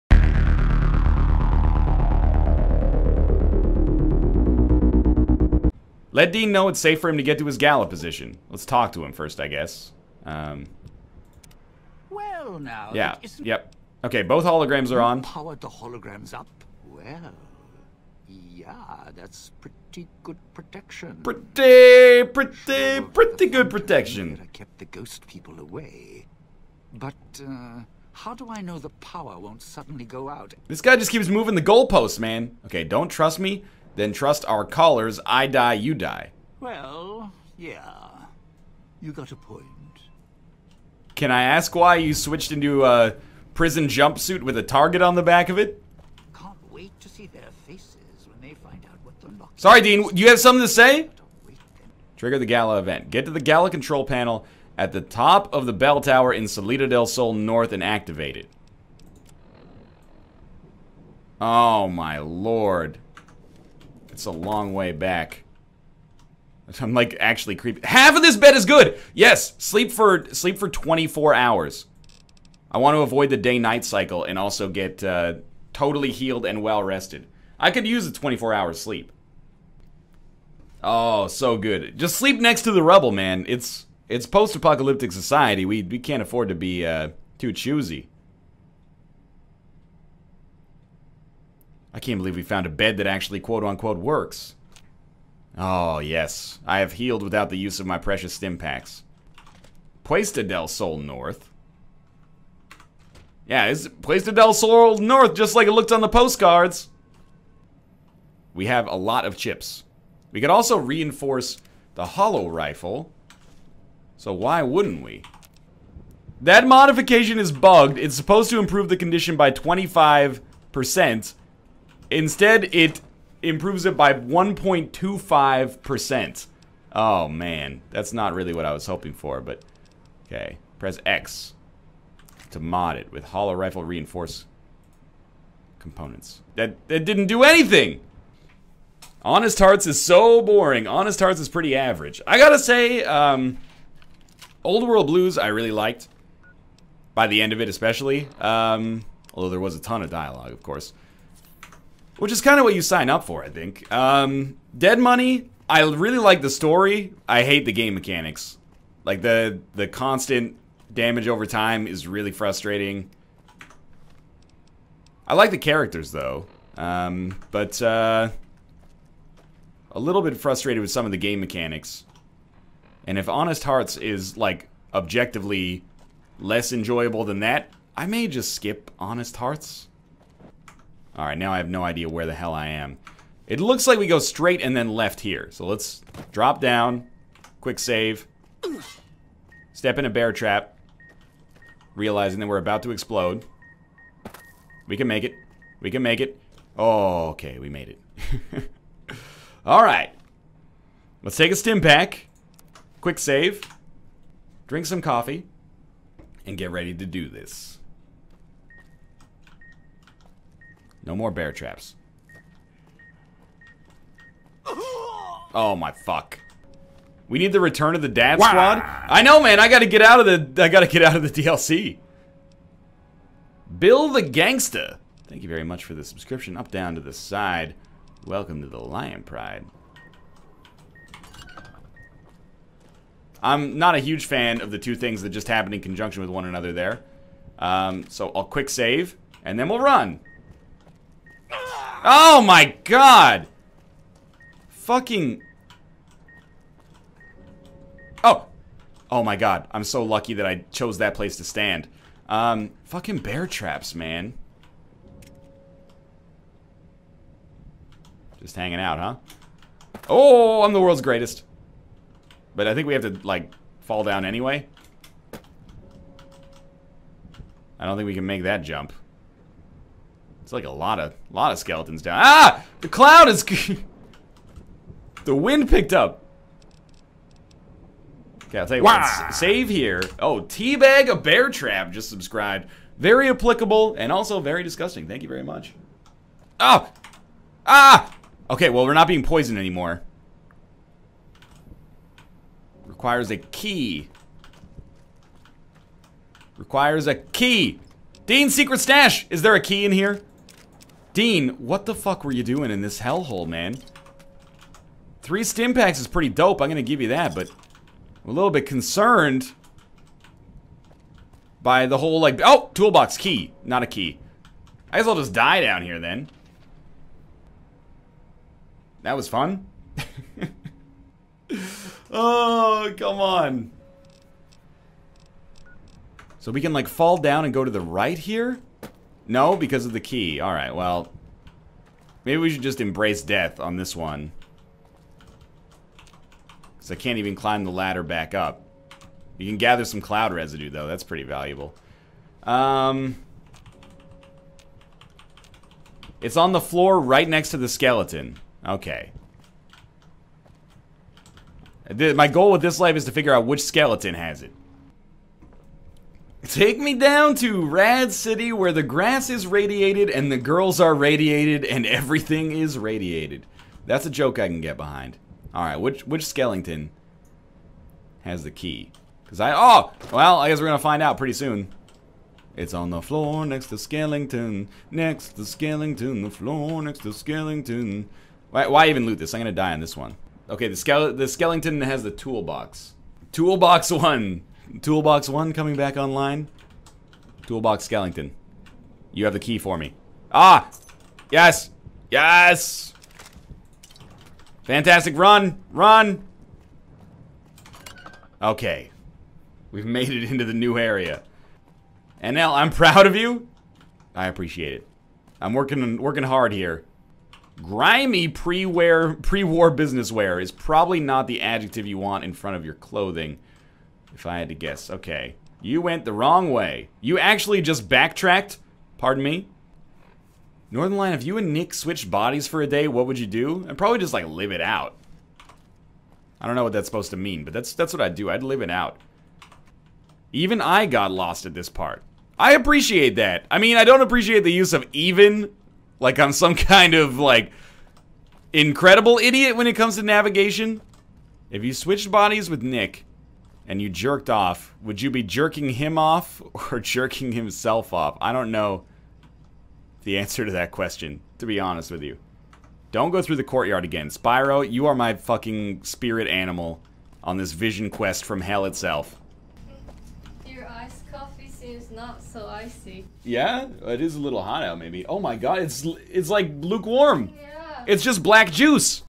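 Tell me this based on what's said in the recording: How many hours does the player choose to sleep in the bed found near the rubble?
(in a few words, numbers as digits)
24.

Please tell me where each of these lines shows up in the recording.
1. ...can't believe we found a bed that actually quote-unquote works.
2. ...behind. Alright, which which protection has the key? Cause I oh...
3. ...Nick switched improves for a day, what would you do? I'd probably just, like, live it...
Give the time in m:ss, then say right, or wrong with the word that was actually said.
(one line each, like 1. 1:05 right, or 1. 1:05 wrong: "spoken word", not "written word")
1. 1:31 right
2. 6:04 wrong: "skeleton", not "protection"
3. 7:01 wrong: "bodies", not "improves".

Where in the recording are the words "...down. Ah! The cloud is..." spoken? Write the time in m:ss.
4:32.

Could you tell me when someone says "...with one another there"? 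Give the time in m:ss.
3:56.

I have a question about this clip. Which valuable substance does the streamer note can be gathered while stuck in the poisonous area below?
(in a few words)
cloud residue.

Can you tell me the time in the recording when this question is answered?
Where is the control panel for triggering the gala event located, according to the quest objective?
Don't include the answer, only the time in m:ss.
0:55.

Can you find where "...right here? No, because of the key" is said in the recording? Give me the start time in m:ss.
5:27.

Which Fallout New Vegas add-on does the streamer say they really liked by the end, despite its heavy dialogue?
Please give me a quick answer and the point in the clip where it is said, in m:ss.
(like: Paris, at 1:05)
Old World Blues, at 2:24.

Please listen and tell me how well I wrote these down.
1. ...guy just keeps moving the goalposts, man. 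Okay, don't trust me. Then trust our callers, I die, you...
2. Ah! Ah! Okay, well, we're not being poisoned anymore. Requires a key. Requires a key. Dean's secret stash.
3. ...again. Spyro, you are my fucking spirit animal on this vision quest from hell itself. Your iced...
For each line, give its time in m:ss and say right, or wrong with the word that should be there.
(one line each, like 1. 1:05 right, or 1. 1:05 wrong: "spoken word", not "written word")
1. 0:30 right
2. 4:46 right
3. 7:33 right.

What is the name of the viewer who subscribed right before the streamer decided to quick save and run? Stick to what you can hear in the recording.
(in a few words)
Bill the Gangsta.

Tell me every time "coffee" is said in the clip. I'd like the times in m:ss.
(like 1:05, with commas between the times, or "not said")
3:25, 7:41.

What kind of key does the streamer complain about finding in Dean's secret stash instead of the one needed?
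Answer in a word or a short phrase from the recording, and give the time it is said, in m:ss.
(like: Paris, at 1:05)
toolbox key, at 5:12.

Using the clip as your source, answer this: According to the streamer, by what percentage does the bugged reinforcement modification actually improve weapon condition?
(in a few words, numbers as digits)
1.25%.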